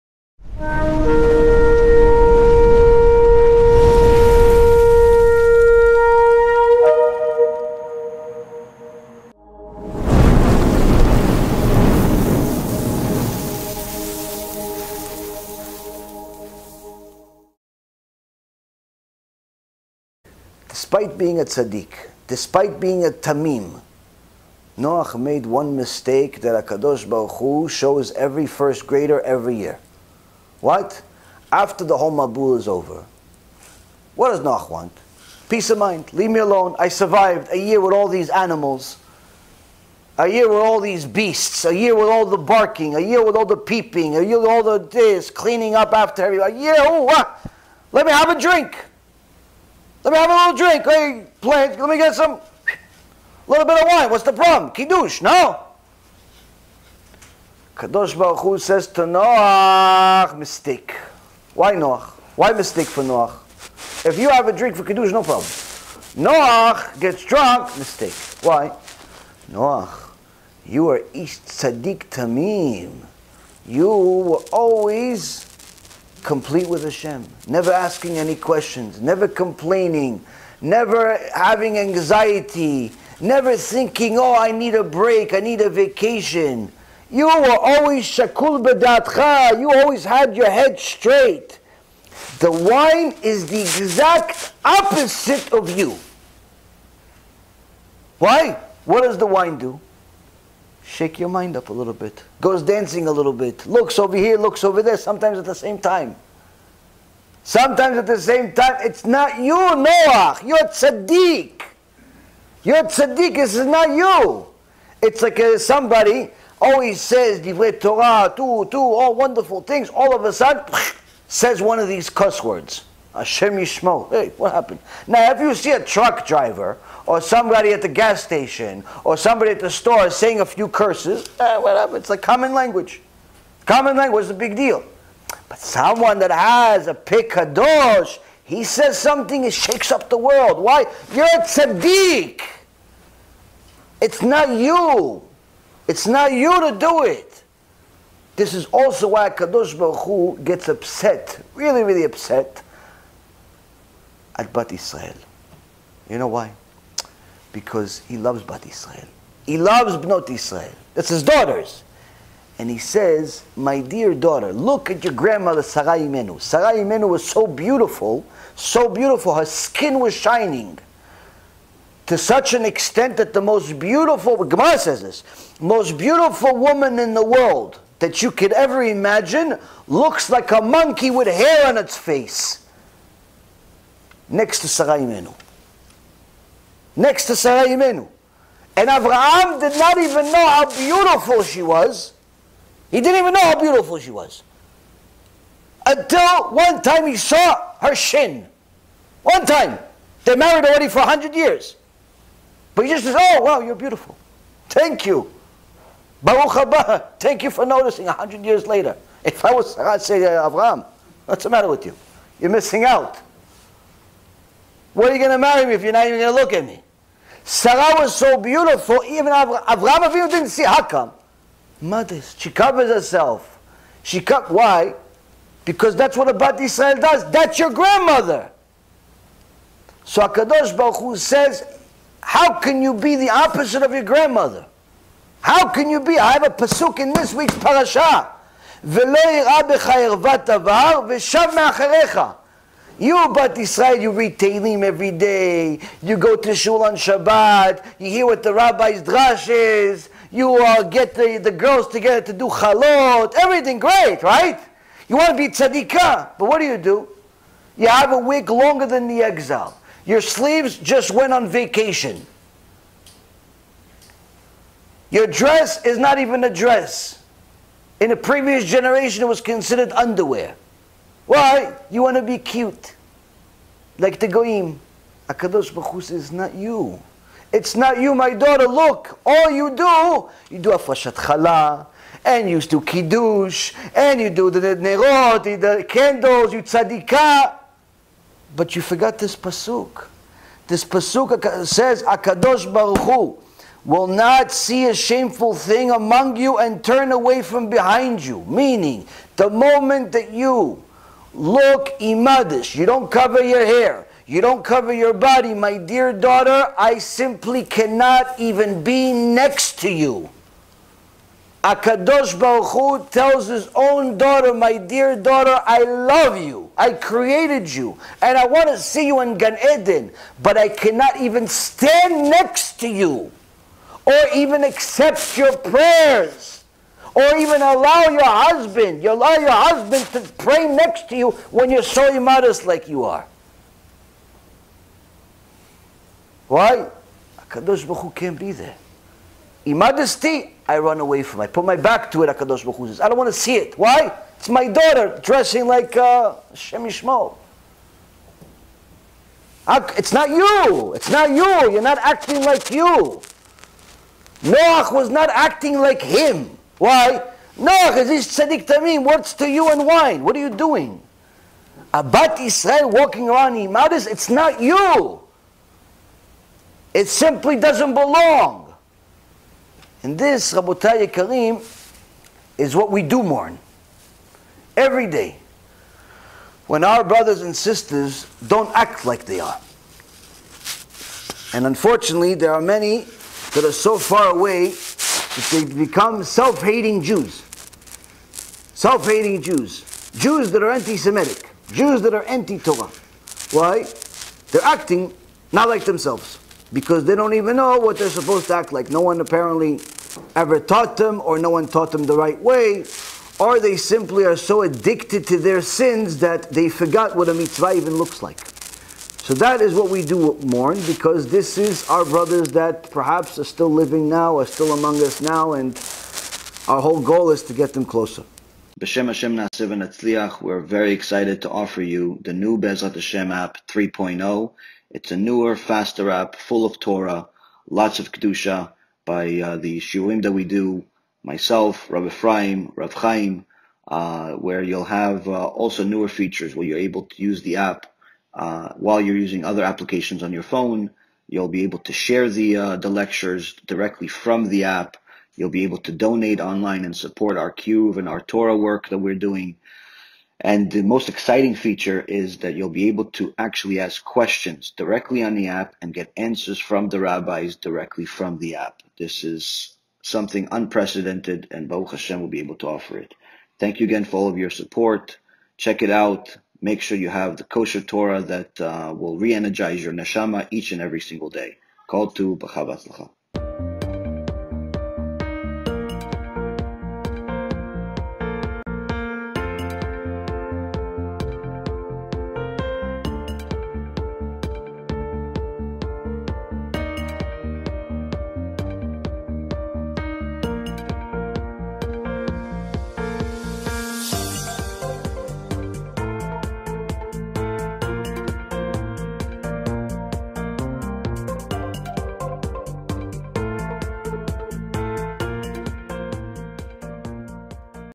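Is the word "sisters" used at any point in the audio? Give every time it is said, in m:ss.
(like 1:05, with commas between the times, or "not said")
6:17.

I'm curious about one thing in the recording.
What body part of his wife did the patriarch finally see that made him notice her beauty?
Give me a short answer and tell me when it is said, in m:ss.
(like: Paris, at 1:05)
shin, at 3:17.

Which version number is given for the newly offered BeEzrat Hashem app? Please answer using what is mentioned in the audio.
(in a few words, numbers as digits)
3.0.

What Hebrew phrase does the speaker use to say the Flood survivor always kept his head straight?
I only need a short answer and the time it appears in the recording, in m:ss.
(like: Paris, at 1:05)
shakul bedatcha, at 1:28.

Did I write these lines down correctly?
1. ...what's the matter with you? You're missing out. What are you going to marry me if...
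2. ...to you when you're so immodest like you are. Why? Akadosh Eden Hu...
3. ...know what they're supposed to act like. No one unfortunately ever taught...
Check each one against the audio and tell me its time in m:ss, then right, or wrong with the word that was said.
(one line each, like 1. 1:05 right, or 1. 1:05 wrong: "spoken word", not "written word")
1. 3:31 right
2. 5:31 wrong: "Baruch", not "Eden"
3. 6:37 wrong: "apparently", not "unfortunately".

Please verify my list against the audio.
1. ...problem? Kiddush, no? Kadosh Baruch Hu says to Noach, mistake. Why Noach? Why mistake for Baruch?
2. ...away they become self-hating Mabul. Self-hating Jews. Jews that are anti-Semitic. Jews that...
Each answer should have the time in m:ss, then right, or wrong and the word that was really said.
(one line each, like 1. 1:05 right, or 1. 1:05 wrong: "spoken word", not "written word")
1. 0:54 wrong: "Noach", not "Baruch"
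2. 6:24 wrong: "Jews", not "Mabul".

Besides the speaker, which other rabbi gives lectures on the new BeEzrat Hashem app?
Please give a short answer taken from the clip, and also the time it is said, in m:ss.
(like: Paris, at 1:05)
Rav Chaim, at 7:12.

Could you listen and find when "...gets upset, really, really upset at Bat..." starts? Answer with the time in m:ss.
2:30.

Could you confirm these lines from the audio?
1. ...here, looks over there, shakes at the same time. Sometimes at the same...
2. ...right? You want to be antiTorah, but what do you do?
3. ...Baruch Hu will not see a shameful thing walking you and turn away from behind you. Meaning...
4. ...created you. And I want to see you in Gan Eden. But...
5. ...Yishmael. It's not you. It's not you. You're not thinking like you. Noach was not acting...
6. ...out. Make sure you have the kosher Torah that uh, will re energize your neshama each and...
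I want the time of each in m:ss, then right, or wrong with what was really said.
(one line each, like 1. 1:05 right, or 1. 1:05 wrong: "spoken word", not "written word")
1. 1:44 wrong: "sometimes", not "shakes"
2. 4:14 wrong: "tzaddikah", not "antiTorah"
3. 4:52 wrong: "among", not "walking"
4. 5:16 right
5. 5:46 wrong: "acting", not "thinking"
6. 7:45 right.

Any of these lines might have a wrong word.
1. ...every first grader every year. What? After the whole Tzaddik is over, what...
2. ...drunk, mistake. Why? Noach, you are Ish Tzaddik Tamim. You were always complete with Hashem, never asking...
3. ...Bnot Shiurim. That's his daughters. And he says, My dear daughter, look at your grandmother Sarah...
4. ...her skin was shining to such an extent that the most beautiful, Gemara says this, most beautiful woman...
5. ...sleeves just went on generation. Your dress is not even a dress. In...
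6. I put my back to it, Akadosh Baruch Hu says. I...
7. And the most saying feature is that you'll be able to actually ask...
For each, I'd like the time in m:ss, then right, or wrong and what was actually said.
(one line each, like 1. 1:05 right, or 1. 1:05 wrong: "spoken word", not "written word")
1. 0:28 wrong: "Mabul", not "Tzaddik"
2. 1:07 right
3. 2:39 wrong: "Israel", not "Shiurim"
4. 2:49 right
5. 4:20 wrong: "vacation", not "generation"
6. 5:41 right
7. 7:30 wrong: "exciting", not "saying".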